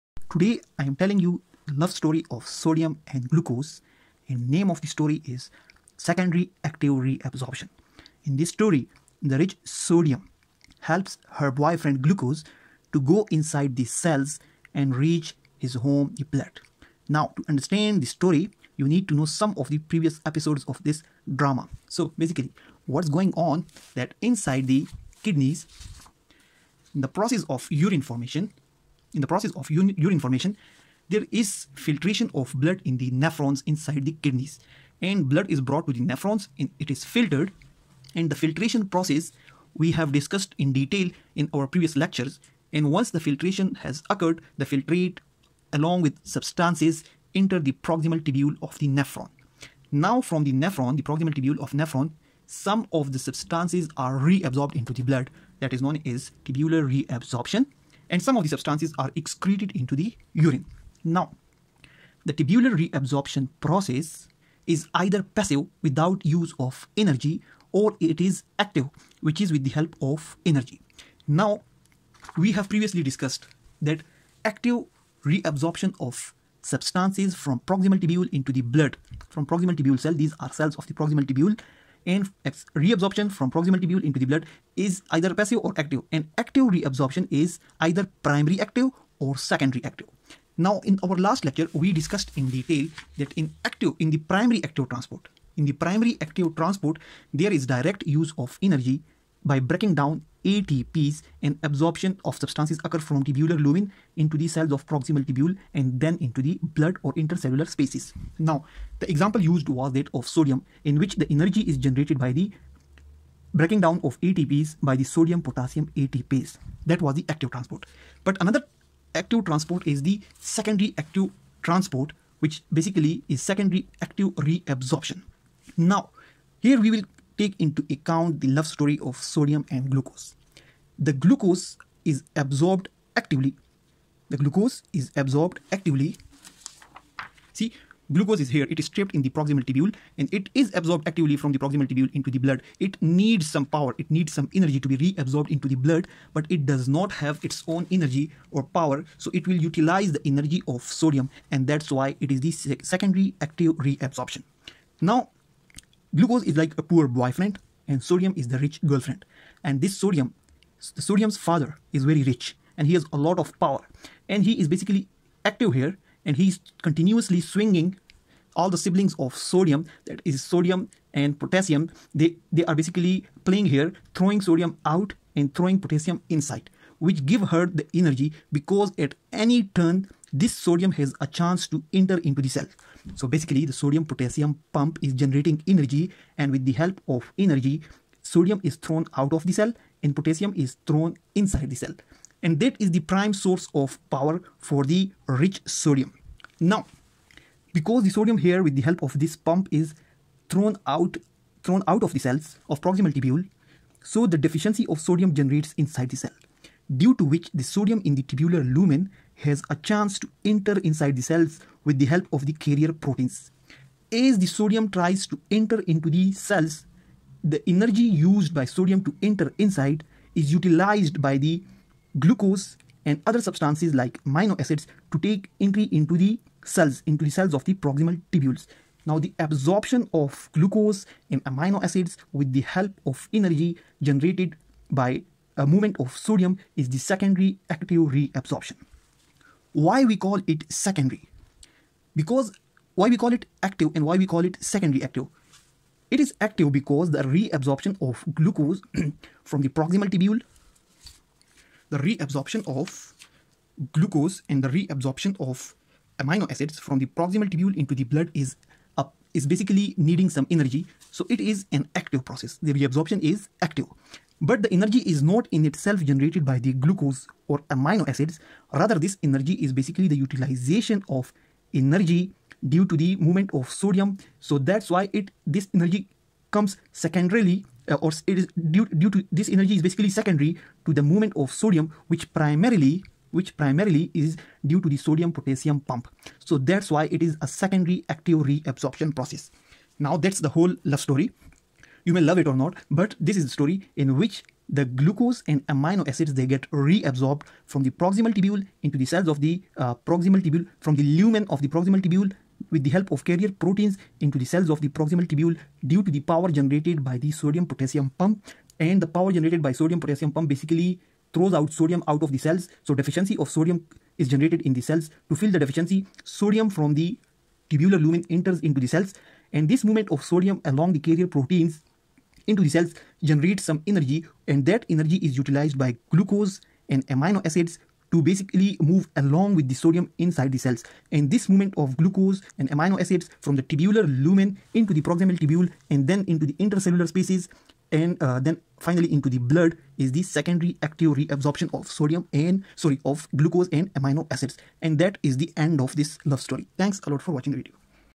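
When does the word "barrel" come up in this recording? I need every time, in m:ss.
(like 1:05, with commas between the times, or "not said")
not said.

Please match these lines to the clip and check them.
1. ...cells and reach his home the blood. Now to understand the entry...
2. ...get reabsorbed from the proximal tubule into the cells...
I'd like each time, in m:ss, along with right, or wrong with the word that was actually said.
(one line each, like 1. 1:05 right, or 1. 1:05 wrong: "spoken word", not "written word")
1. 0:13 wrong: "story", not "entry"
2. 4:56 right.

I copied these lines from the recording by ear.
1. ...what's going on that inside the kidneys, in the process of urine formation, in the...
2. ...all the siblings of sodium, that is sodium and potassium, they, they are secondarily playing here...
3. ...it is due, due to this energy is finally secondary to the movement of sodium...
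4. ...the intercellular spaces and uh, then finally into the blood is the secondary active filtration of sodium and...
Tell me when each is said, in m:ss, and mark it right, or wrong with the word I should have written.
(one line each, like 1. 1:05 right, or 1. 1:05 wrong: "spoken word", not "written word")
1. 0:22 right
2. 2:48 wrong: "basically", not "secondarily"
3. 4:38 wrong: "basically", not "finally"
4. 5:36 wrong: "reabsorption", not "filtration".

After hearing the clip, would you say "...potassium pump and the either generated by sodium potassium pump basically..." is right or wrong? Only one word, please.
wrong.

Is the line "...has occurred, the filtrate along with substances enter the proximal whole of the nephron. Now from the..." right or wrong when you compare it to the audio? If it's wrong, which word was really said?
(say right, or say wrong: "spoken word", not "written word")
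wrong: "tubule", not "whole".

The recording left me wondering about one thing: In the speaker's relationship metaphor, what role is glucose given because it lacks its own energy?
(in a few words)
poor boyfriend.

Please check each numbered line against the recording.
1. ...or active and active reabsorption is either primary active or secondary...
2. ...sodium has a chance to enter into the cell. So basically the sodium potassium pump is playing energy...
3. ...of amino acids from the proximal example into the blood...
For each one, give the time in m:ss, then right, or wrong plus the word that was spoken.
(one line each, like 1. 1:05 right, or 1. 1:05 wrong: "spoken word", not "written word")
1. 1:25 right
2. 3:00 wrong: "generating", not "playing"
3. 4:15 wrong: "tubule", not "example".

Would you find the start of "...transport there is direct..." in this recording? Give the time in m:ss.
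1:36.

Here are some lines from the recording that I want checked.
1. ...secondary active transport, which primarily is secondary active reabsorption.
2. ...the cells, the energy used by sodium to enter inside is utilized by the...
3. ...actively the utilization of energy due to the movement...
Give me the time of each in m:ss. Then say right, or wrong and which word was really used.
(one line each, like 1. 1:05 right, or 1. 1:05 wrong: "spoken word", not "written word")
1. 2:00 wrong: "basically", not "primarily"
2. 3:36 right
3. 4:29 wrong: "basically", not "actively".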